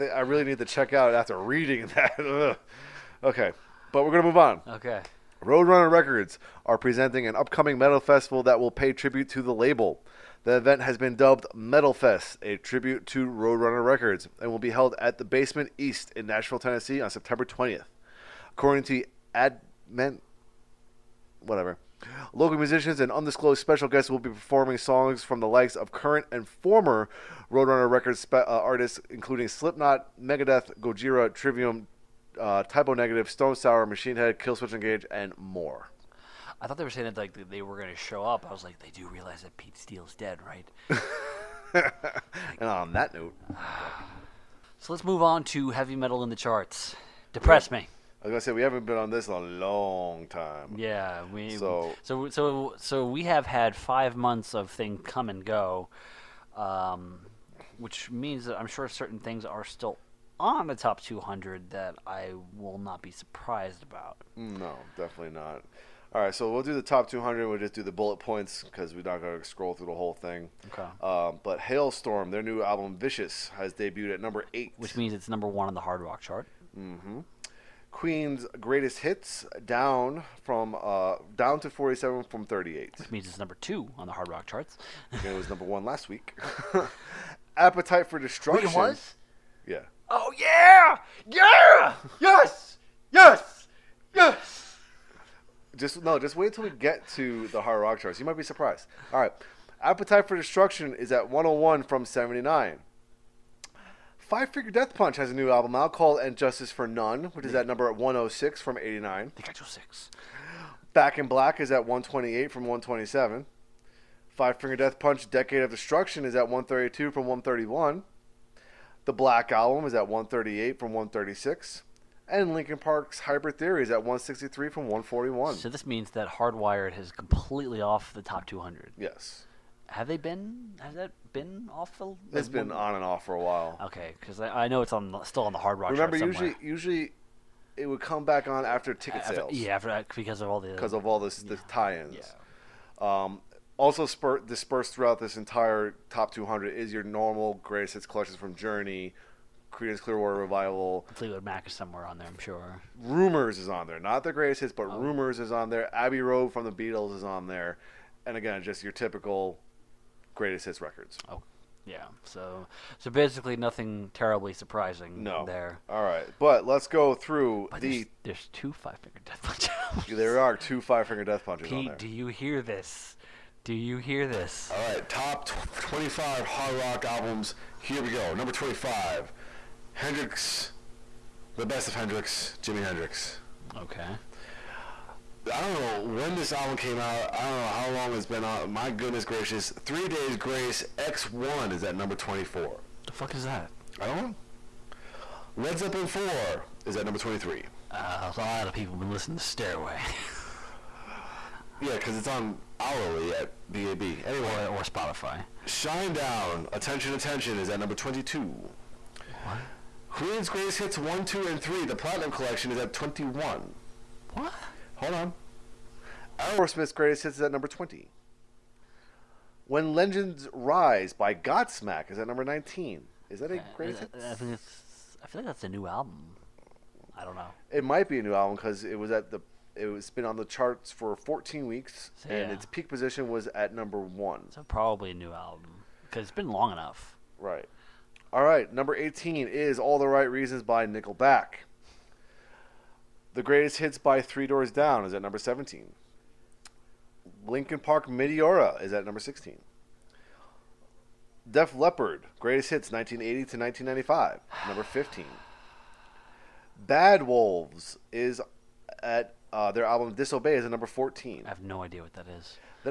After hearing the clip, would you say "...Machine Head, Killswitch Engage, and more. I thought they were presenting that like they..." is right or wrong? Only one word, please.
wrong.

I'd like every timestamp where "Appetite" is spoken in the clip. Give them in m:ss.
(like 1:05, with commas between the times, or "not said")
1:27, 1:39.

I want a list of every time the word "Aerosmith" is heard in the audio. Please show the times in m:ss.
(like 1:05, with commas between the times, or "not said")
3:36.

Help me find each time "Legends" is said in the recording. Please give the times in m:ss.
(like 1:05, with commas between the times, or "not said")
3:39.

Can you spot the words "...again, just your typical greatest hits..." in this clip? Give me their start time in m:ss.
2:38.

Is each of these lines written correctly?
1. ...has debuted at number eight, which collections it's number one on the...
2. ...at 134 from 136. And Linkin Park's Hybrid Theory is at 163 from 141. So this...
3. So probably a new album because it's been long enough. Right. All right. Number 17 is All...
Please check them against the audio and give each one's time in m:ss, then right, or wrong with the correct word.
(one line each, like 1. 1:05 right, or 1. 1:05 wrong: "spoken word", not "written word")
1. 1:13 wrong: "means", not "collections"
2. 1:59 wrong: "138", not "134"
3. 3:54 wrong: "18", not "17".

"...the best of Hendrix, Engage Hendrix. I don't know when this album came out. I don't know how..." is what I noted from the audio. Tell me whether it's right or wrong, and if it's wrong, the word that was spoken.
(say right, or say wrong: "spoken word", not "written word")
wrong: "Jimi", not "Engage".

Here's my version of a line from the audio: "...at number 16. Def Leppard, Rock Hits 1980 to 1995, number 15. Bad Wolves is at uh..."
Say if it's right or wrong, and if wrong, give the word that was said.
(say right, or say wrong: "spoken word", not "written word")
wrong: "Greatest", not "Rock".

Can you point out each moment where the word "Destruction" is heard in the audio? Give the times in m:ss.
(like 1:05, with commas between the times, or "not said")
1:28, 1:40, 1:55.